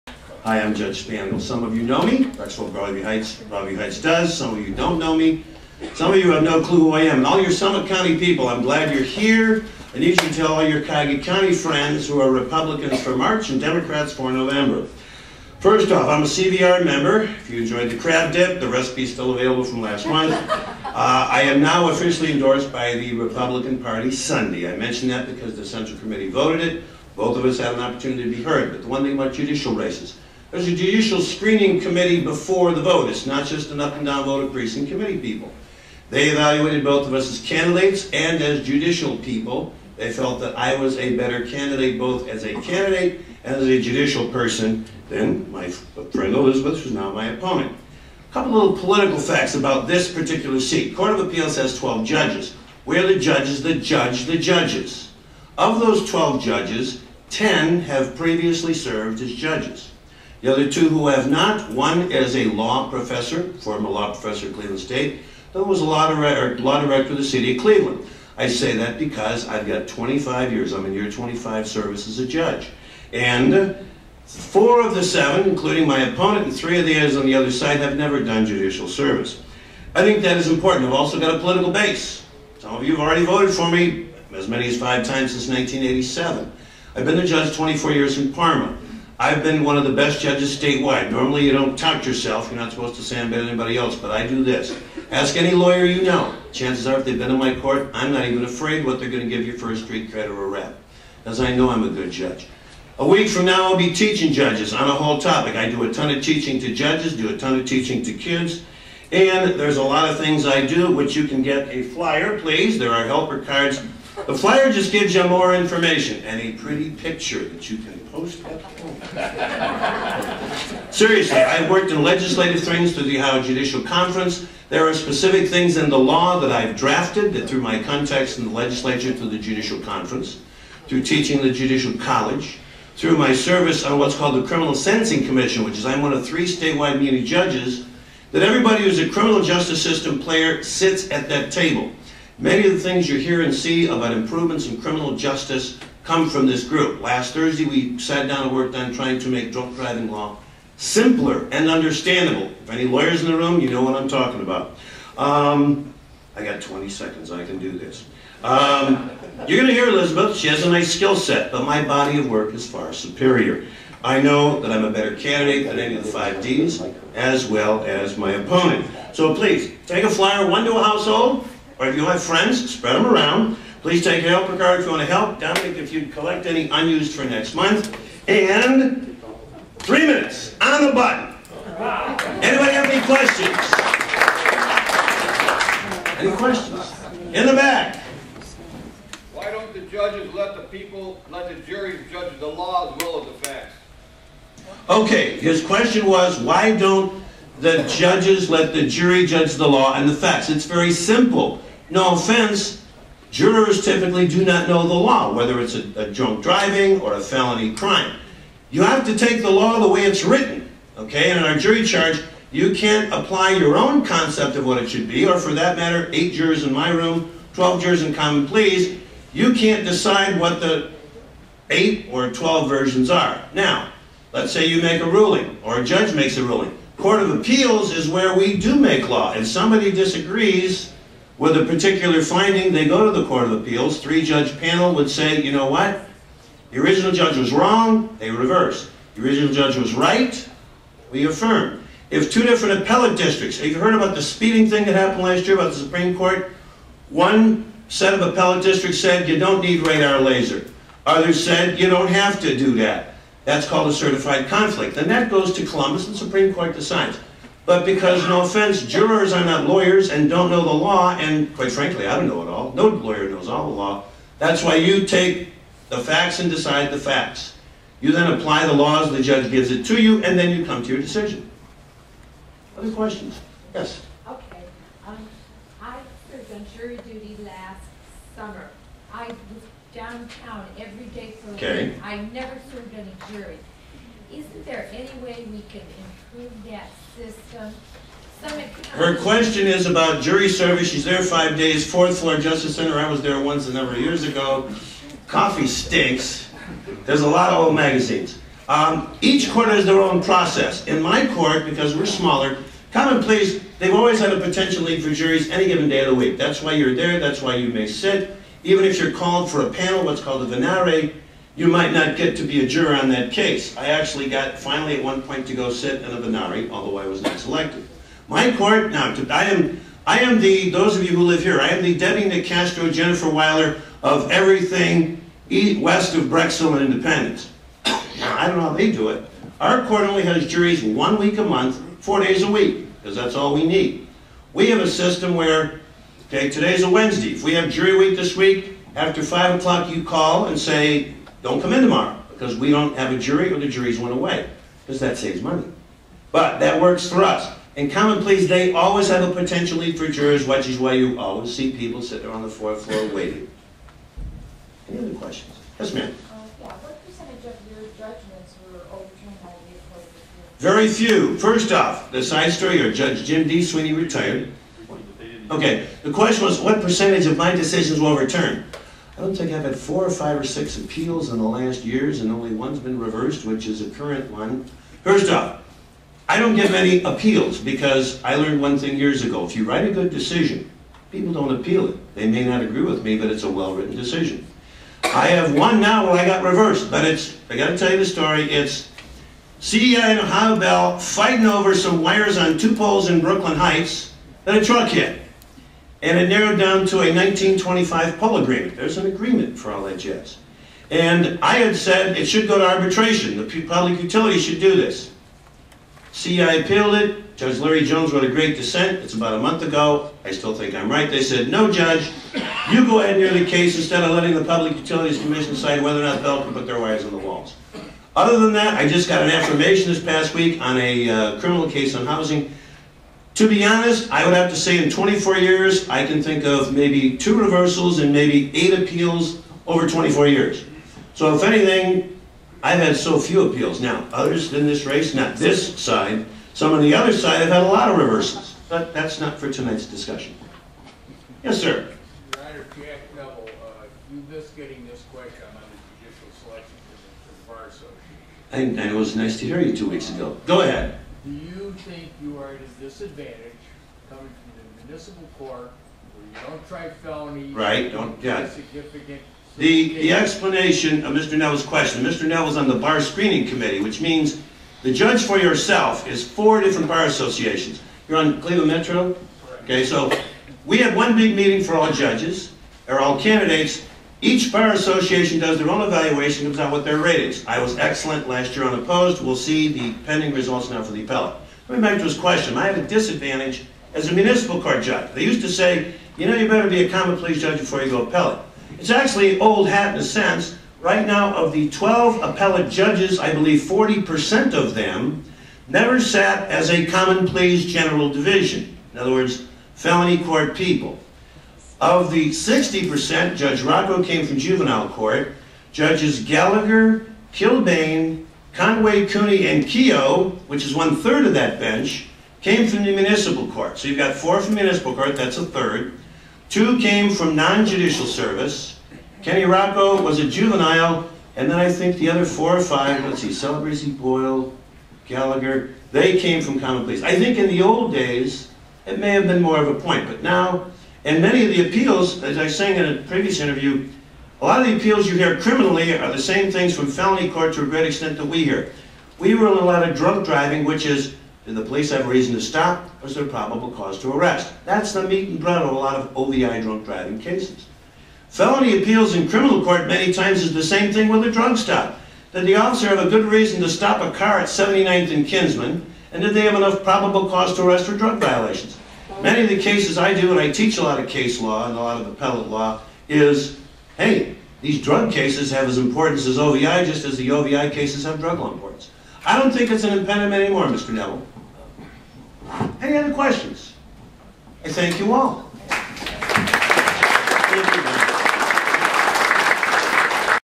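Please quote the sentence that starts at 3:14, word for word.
Okay, his question was, why don't the judges let the jury judge the law and the facts?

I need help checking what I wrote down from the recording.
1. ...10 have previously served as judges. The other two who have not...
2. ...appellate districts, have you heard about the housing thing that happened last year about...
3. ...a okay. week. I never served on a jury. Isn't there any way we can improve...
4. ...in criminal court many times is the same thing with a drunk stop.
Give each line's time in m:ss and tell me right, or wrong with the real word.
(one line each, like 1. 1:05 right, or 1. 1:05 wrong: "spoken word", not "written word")
1. 0:57 right
2. 4:02 wrong: "speeding", not "housing"
3. 4:41 right
4. 9:09 right.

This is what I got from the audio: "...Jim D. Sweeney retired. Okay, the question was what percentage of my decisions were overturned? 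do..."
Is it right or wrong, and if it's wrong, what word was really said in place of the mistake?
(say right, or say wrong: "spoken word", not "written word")
right.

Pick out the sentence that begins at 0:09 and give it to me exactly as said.
I need you to tell all your Cuyahoga County friends who are Republicans for March and Democrats for November.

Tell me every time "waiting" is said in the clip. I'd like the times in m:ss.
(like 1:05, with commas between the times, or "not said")
5:53.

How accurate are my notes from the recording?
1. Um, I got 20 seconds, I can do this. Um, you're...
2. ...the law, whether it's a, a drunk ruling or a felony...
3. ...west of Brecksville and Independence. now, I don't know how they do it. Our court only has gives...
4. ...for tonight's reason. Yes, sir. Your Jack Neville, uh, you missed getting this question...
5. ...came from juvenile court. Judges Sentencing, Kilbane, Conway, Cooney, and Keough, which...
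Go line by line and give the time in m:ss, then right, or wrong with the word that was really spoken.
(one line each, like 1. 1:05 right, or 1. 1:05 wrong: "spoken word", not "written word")
1. 2:35 right
2. 3:24 wrong: "driving", not "ruling"
3. 5:25 wrong: "juries", not "gives"
4. 7:19 wrong: "discussion", not "reason"
5. 8:24 wrong: "Gallagher", not "Sentencing".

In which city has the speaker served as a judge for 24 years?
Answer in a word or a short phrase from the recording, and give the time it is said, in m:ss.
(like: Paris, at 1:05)
Parma, at 1:28.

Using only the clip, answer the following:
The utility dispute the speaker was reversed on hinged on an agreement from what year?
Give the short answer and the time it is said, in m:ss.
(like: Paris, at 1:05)
1925, at 6:37.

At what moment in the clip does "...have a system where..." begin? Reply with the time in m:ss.
5:34.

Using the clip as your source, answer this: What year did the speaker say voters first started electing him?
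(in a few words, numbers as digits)
1987.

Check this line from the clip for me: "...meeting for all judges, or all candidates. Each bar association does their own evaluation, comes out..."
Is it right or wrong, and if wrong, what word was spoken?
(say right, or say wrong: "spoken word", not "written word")
right.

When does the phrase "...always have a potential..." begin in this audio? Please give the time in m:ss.
5:48.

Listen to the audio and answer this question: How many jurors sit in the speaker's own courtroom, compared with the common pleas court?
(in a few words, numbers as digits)
8.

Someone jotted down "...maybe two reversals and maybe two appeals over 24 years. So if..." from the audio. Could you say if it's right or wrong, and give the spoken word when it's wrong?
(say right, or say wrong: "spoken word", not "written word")
wrong: "eight", not "two".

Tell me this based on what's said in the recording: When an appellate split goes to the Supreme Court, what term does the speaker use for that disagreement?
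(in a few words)
certified conflict.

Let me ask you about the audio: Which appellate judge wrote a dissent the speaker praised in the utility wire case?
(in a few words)
Larry Jones.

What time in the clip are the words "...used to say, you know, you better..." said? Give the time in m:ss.
8:05.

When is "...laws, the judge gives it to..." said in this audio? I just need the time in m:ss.
4:28.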